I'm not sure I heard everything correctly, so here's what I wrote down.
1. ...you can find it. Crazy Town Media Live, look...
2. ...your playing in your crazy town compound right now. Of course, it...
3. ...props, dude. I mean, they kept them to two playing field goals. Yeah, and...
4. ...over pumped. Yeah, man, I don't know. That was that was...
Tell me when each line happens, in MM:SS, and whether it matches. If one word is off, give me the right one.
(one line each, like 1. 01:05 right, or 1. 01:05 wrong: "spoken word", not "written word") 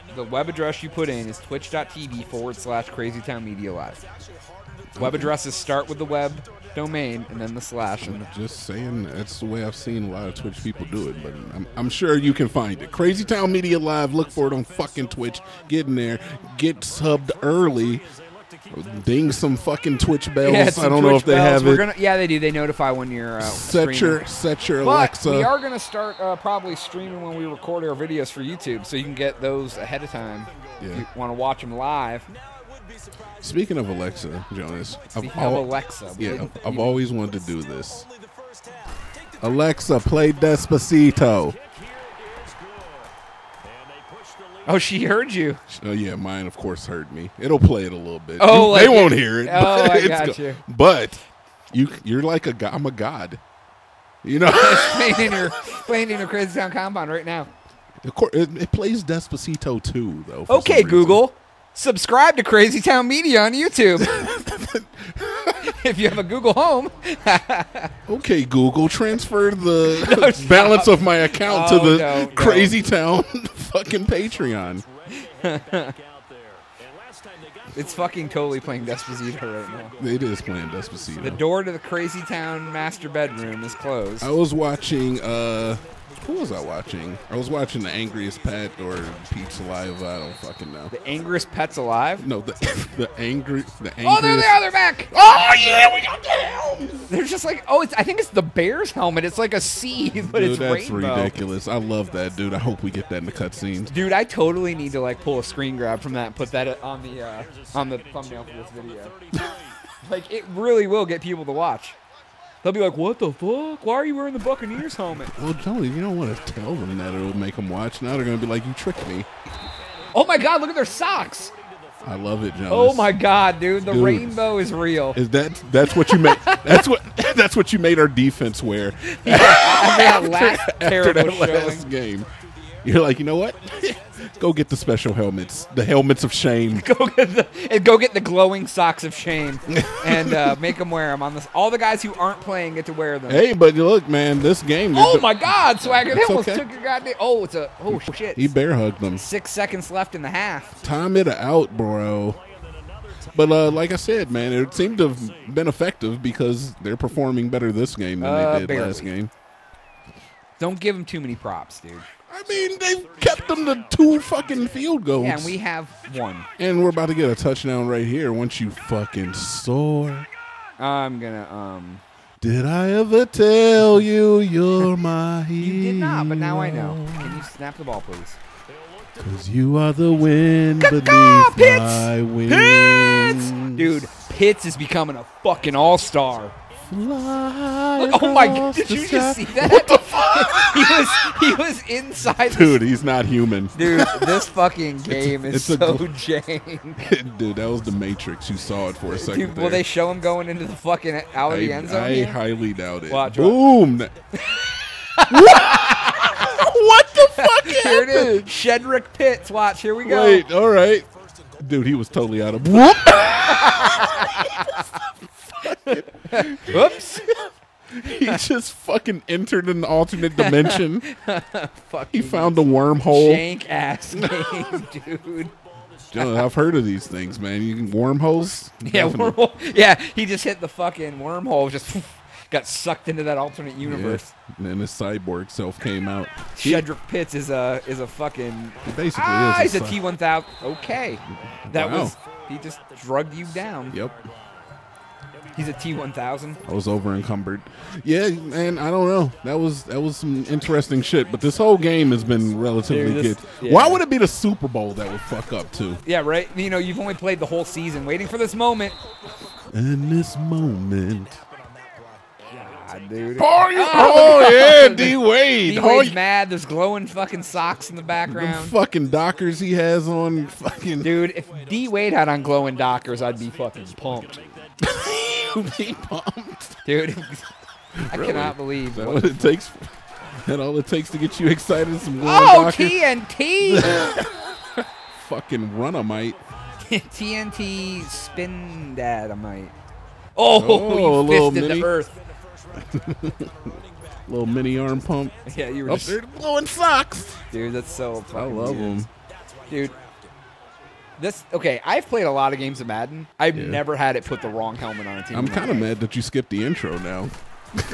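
1. 00:12 right
2. 00:55 right
3. 02:41 wrong: "fucking", not "playing"
4. 04:06 wrong: "encumbered", not "pumped".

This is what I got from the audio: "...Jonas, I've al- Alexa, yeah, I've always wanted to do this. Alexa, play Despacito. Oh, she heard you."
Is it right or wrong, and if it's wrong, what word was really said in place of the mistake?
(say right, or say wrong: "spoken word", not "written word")
right.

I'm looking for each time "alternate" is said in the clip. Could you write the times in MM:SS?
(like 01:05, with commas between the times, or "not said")
03:39, 03:53.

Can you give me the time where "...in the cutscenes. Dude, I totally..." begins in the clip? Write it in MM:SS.
01:43.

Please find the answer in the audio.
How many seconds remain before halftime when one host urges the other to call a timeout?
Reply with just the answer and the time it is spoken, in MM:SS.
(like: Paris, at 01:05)
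6, at 02:29.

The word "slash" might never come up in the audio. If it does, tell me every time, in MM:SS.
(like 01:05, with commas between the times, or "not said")
00:02, 00:07.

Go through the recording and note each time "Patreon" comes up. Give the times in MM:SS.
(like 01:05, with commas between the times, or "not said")
01:14.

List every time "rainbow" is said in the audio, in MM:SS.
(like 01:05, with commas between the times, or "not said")
01:40, 02:04.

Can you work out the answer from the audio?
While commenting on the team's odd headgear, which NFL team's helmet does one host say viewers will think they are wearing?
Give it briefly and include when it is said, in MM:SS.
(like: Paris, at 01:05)
Buccaneers, at 01:53.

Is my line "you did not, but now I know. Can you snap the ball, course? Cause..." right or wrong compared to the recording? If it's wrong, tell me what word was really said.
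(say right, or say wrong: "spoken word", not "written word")
wrong: "please", not "course".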